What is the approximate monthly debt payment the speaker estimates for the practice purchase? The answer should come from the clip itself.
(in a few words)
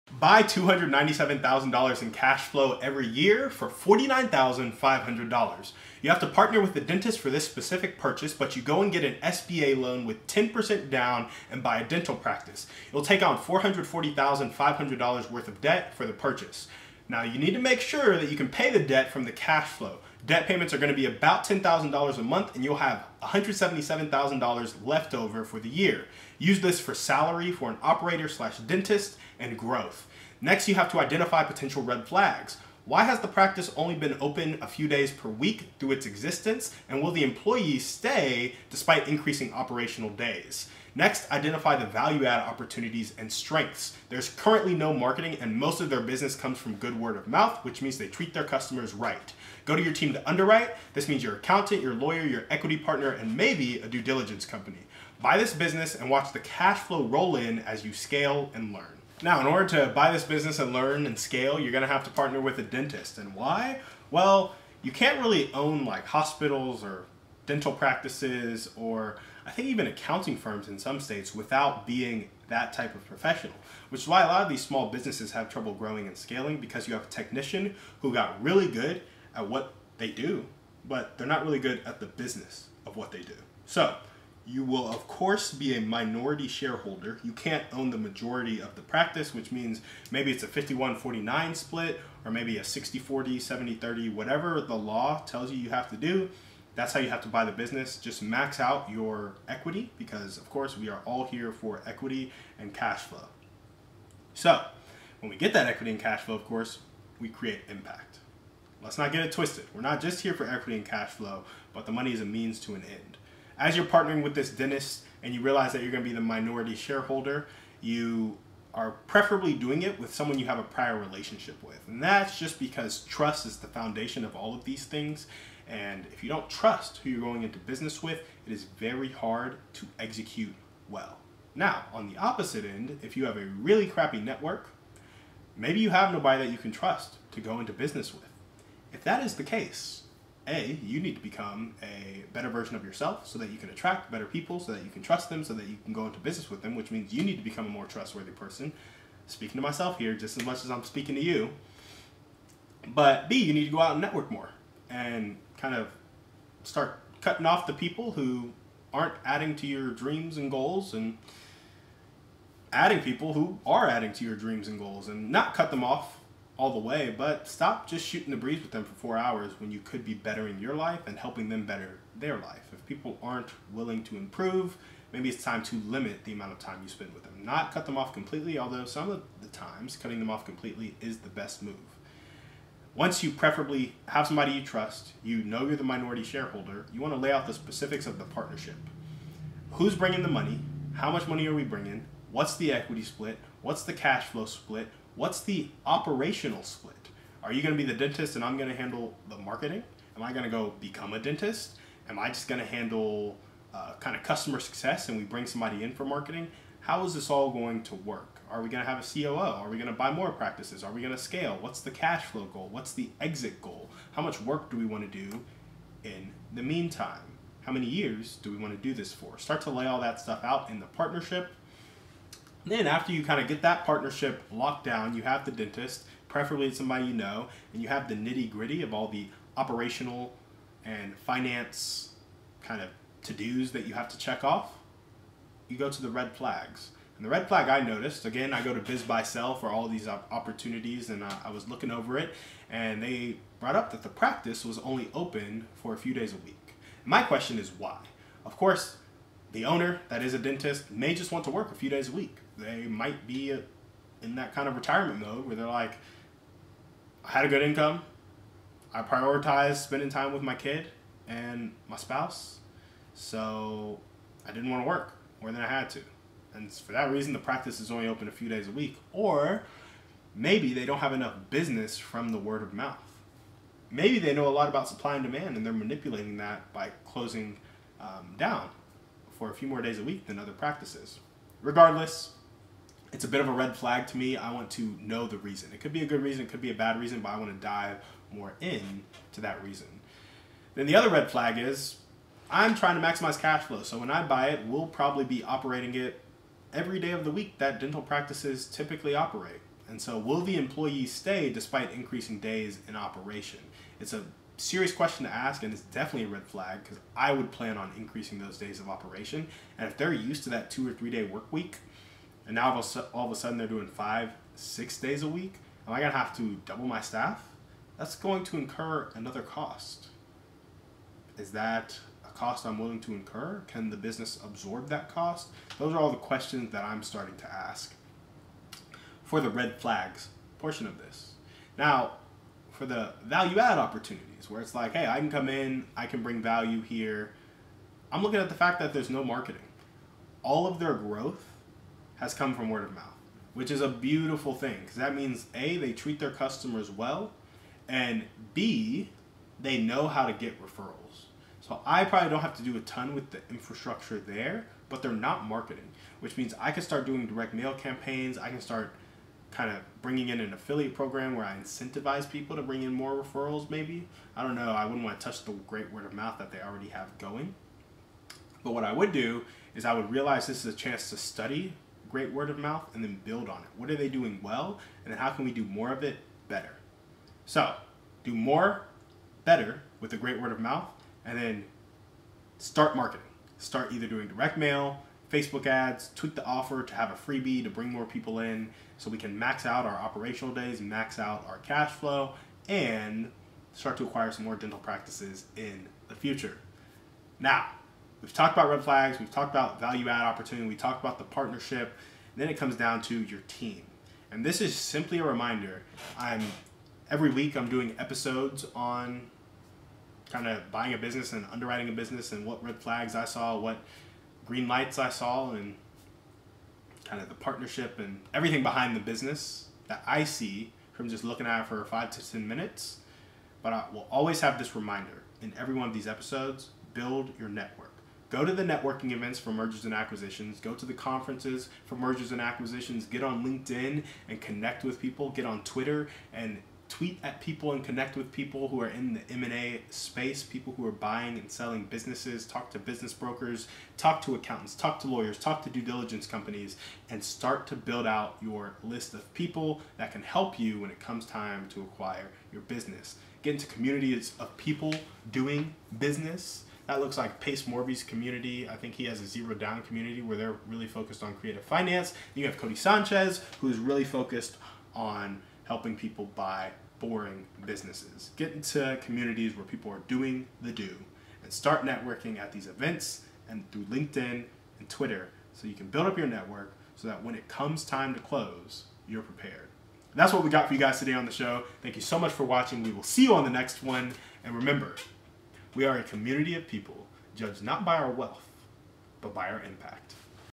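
$10,000.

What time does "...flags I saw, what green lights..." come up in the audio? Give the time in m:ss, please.
6:52.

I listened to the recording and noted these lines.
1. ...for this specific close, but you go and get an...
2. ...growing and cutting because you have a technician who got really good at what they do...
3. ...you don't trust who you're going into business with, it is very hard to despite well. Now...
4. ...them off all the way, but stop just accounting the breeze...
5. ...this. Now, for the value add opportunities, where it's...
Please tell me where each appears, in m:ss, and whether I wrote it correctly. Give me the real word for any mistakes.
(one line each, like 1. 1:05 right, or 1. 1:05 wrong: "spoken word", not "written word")
1. 0:07 wrong: "purchase", not "close"
2. 1:15 wrong: "scaling", not "cutting"
3. 2:06 wrong: "execute", not "despite"
4. 2:45 wrong: "shooting", not "accounting"
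5. 5:30 right.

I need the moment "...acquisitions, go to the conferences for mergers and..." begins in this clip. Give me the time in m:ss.
7:09.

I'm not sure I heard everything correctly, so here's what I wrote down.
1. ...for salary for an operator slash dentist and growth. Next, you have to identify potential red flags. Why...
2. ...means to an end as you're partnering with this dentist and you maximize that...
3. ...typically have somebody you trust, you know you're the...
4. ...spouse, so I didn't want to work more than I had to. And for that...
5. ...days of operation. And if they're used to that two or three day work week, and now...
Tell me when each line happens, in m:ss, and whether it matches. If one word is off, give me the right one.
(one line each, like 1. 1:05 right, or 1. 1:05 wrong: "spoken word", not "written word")
1. 0:26 right
2. 1:52 wrong: "realize", not "maximize"
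3. 3:03 wrong: "preferably", not "typically"
4. 4:21 right
5. 5:08 right.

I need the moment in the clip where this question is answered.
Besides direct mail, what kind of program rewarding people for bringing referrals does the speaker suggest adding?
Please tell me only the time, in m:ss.
6:00.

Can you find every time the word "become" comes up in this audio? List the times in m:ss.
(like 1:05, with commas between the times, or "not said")
2:21, 2:27, 3:20.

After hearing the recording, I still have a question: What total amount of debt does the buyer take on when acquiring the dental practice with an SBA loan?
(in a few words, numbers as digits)
$440,500.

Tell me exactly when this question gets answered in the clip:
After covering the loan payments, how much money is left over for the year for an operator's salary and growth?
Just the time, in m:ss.
0:23.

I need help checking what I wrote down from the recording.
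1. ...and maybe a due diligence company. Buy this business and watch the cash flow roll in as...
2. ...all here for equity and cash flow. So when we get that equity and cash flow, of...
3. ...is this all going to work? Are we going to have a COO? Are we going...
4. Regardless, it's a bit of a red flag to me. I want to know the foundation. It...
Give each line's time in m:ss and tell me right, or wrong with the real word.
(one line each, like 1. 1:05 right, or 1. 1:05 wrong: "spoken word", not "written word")
1. 0:53 right
2. 1:41 right
3. 3:27 right
4. 4:41 wrong: "reason", not "foundation".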